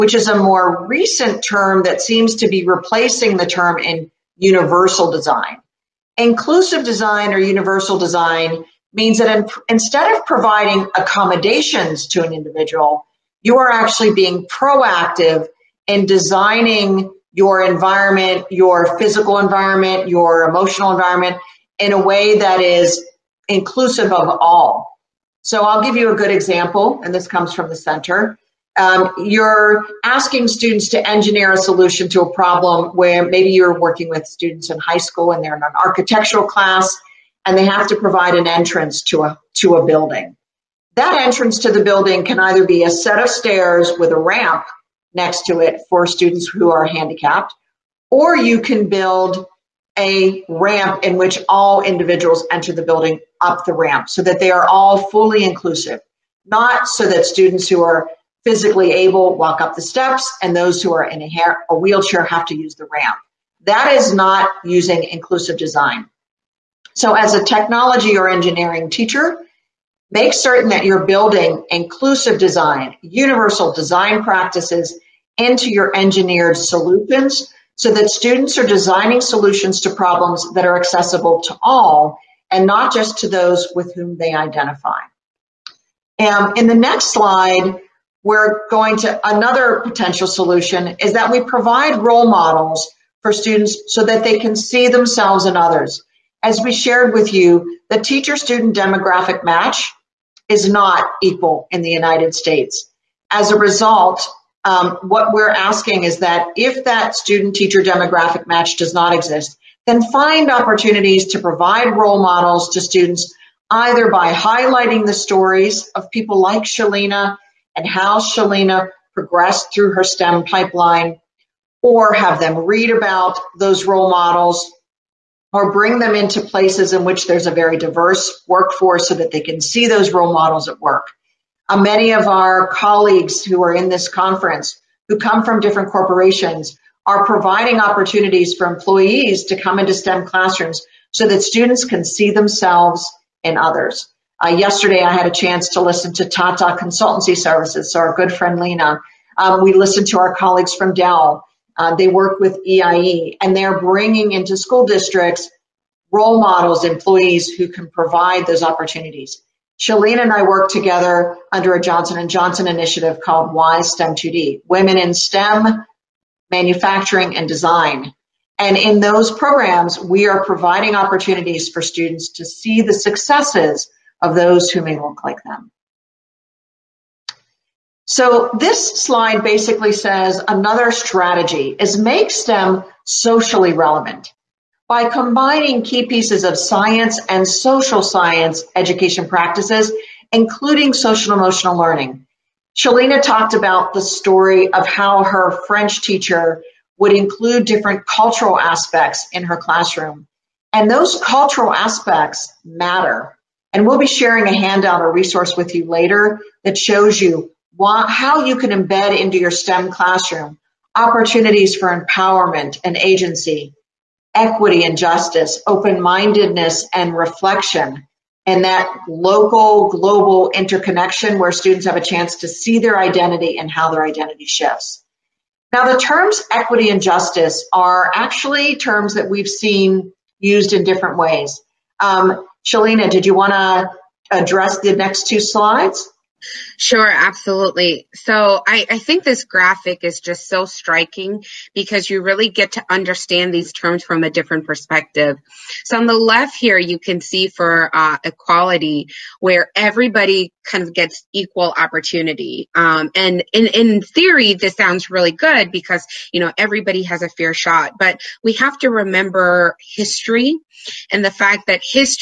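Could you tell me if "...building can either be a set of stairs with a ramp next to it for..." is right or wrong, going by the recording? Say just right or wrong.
right.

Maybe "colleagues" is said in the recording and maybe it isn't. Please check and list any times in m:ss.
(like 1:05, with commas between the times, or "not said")
2:12, 2:30.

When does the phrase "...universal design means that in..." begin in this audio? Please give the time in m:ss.
0:07.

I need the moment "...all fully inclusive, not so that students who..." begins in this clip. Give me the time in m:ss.
0:54.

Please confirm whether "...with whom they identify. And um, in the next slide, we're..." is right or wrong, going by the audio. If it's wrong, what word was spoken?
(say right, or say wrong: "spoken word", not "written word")
right.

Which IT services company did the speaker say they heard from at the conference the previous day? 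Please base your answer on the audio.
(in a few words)
Tata Consultancy Services.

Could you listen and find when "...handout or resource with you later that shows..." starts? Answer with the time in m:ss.
3:24.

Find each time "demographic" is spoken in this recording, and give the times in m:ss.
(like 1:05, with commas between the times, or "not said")
1:38, 1:47.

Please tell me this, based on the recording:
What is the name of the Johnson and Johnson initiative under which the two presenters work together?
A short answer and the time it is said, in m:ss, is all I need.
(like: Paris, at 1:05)
WiSTEM2D, at 2:43.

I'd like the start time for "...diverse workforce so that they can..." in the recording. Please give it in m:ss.
2:07.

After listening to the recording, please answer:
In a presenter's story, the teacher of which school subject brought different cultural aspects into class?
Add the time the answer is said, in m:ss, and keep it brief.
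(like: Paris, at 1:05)
French, at 3:15.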